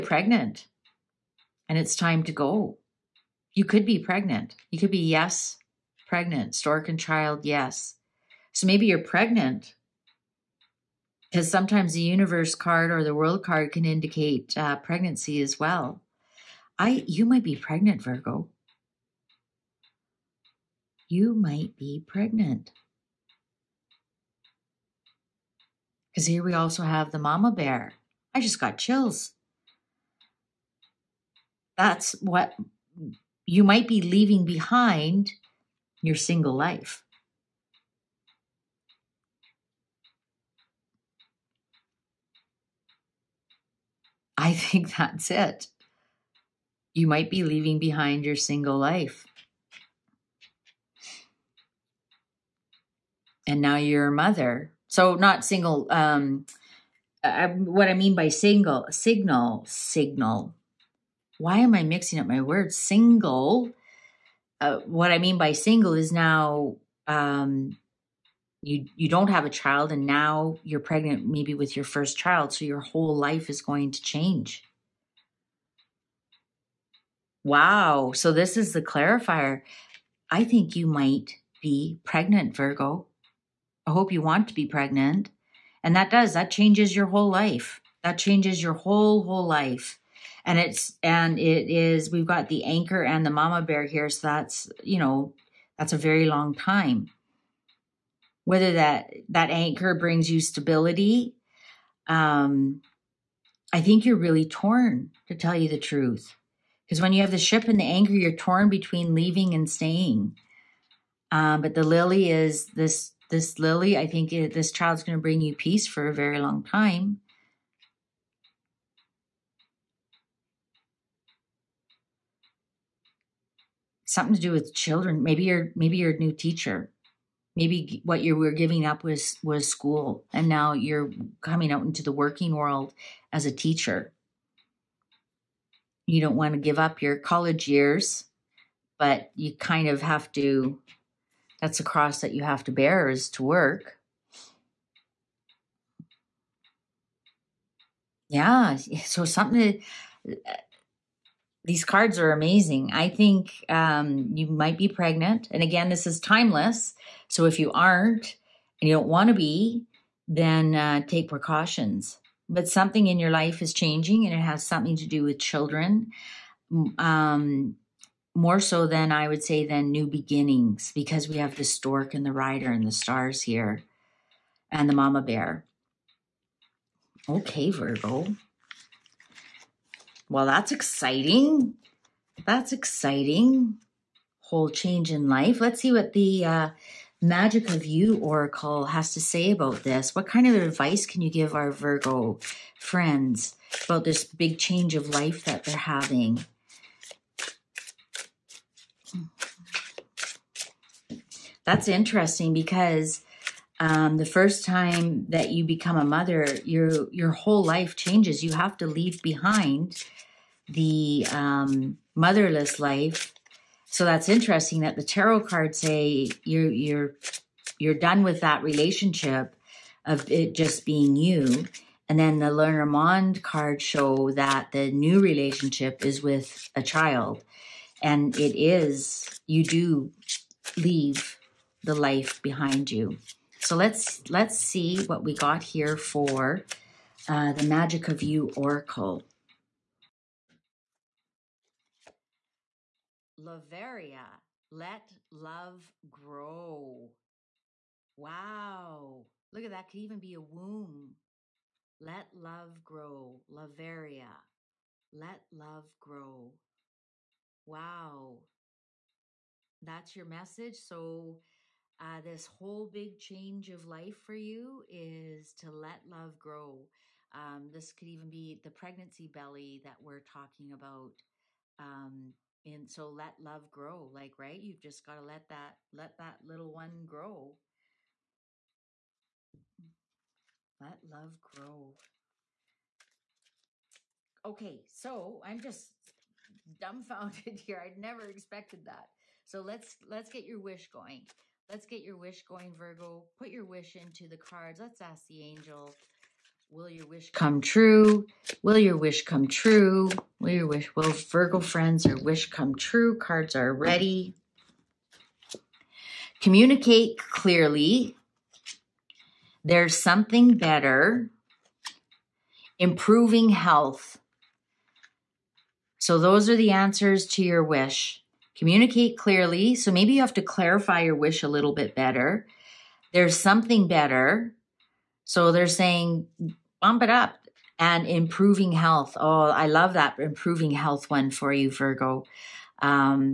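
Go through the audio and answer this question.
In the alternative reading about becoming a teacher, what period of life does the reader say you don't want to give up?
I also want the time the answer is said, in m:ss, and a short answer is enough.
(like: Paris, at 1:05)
college years, at 2:17.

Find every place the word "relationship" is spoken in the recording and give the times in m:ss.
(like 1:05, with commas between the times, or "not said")
3:38, 3:45.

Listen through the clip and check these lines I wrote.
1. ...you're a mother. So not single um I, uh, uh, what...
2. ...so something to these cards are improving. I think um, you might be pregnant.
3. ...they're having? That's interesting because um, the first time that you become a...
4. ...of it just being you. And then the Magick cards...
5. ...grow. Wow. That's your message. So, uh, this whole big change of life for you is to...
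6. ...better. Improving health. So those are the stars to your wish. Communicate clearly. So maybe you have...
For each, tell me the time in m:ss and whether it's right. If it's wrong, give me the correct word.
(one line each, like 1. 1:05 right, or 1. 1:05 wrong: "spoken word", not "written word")
1. 0:53 right
2. 2:28 wrong: "amazing", not "improving"
3. 3:15 right
4. 3:40 wrong: "Mond", not "Magick"
5. 4:15 right
6. 5:10 wrong: "answers", not "stars".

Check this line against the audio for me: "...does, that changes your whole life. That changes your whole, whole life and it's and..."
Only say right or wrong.
right.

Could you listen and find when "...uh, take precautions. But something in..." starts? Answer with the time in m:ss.
2:40.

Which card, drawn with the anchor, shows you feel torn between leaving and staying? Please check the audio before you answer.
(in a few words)
the ship.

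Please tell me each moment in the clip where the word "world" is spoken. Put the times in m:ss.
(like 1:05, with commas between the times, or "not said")
0:13, 2:12.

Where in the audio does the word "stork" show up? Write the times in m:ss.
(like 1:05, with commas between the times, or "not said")
0:06, 2:51.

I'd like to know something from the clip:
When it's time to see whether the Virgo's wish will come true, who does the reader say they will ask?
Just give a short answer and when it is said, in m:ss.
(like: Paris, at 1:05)
the angel, at 4:55.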